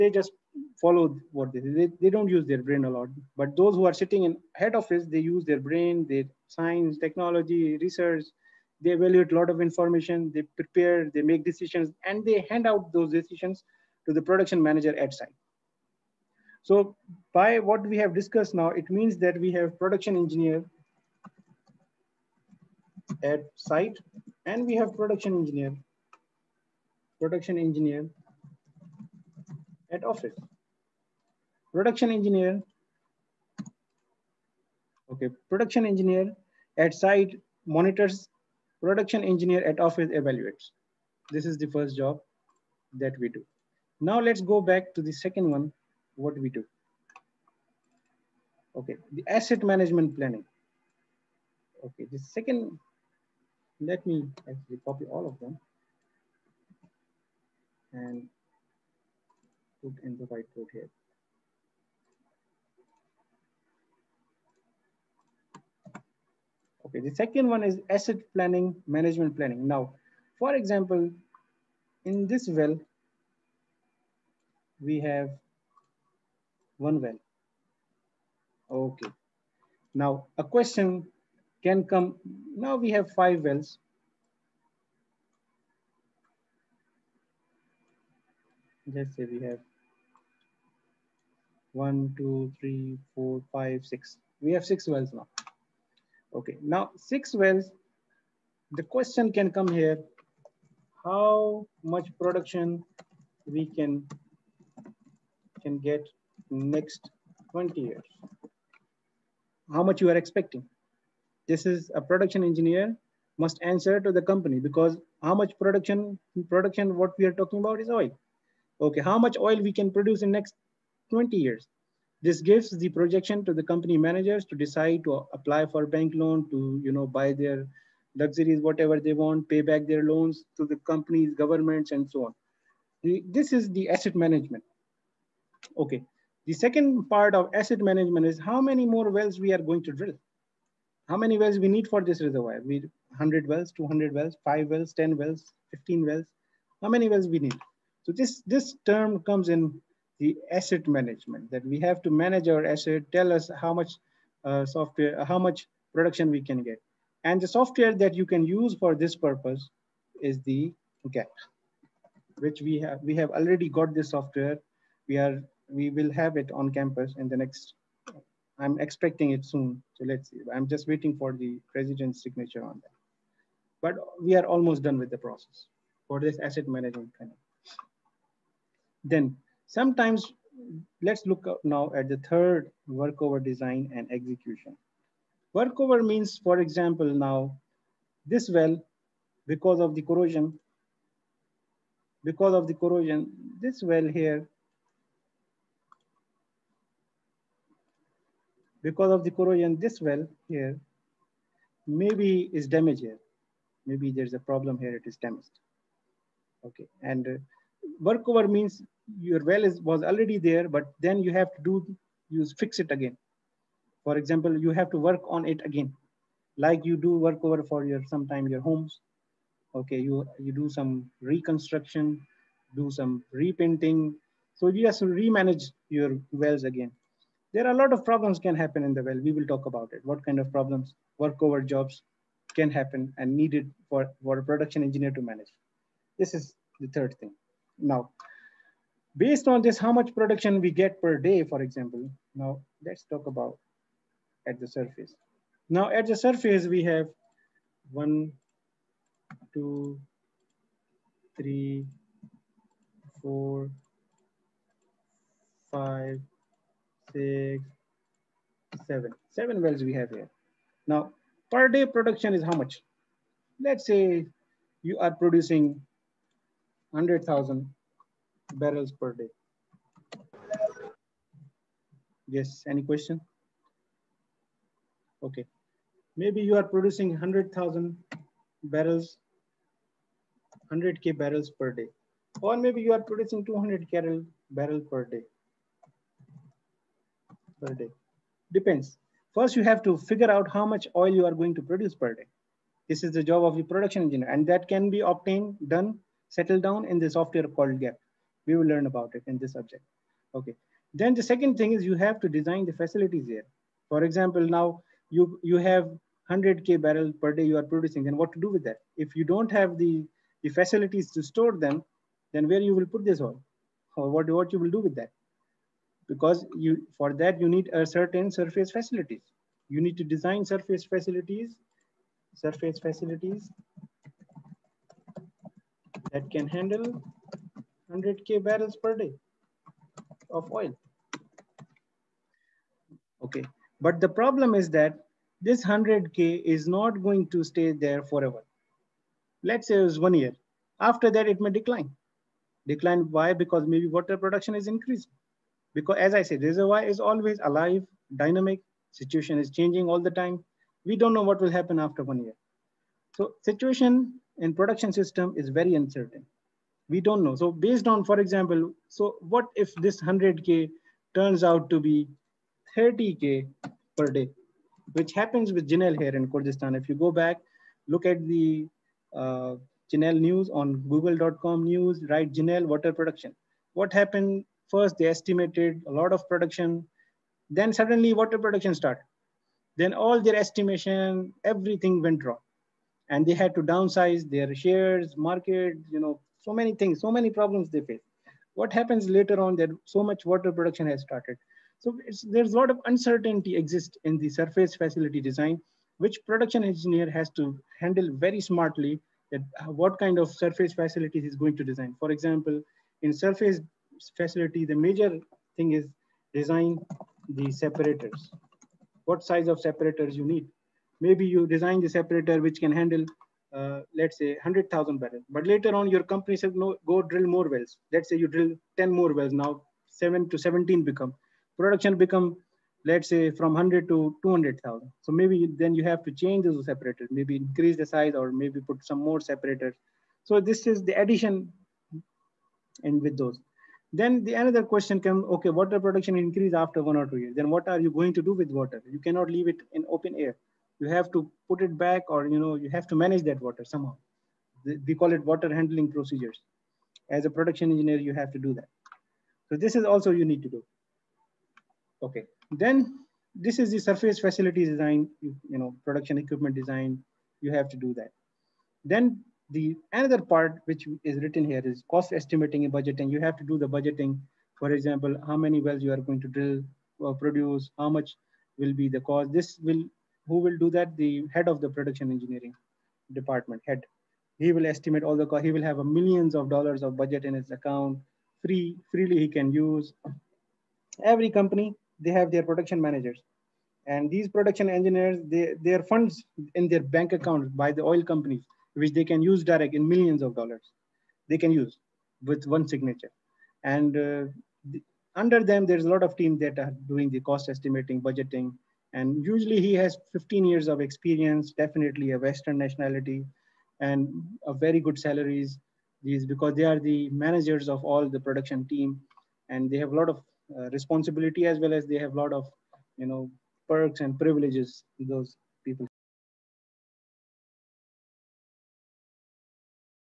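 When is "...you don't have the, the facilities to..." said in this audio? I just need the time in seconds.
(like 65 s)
309 s.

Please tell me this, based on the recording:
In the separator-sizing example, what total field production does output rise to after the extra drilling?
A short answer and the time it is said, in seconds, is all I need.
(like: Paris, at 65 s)
200,000 barrels, at 424 s.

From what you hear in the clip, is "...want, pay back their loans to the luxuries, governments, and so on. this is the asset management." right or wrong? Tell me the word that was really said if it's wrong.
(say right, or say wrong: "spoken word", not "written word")
wrong: "companies", not "luxuries".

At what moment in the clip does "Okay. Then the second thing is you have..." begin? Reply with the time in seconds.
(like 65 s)
300 s.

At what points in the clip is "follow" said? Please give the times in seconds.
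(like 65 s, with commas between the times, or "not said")
0 s.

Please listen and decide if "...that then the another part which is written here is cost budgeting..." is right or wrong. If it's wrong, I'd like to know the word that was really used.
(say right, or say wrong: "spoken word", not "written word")
wrong: "estimating", not "budgeting".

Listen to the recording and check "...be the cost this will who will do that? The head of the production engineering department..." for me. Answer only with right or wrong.
right.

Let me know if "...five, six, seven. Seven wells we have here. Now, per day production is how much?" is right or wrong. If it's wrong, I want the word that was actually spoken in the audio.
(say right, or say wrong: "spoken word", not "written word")
right.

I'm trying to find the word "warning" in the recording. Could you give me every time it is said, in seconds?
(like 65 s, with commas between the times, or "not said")
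not said.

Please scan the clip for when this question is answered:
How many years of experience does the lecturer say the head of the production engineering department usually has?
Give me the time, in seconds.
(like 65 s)
500 s.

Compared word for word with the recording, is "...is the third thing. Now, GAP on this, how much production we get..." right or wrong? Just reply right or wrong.
wrong.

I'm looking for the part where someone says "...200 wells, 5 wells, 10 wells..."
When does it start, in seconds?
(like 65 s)
143 s.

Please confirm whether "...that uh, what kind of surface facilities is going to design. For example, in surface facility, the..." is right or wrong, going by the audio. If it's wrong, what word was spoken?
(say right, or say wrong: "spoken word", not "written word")
right.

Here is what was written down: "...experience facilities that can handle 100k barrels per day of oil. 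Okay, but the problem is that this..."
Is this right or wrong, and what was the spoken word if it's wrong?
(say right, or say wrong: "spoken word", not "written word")
wrong: "surface", not "experience".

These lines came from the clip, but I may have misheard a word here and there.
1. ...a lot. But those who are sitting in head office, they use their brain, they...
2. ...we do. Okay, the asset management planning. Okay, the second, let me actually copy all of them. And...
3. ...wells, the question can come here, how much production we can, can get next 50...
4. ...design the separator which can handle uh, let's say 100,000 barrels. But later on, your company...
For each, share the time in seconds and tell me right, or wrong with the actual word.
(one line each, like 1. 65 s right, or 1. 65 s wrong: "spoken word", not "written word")
1. 2 s right
2. 46 s right
3. 97 s wrong: "20", not "50"
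4. 411 s right.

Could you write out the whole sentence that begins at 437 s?
Then what are you going to do with water?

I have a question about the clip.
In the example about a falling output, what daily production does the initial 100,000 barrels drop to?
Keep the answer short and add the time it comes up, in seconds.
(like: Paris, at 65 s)
30K per day, at 362 s.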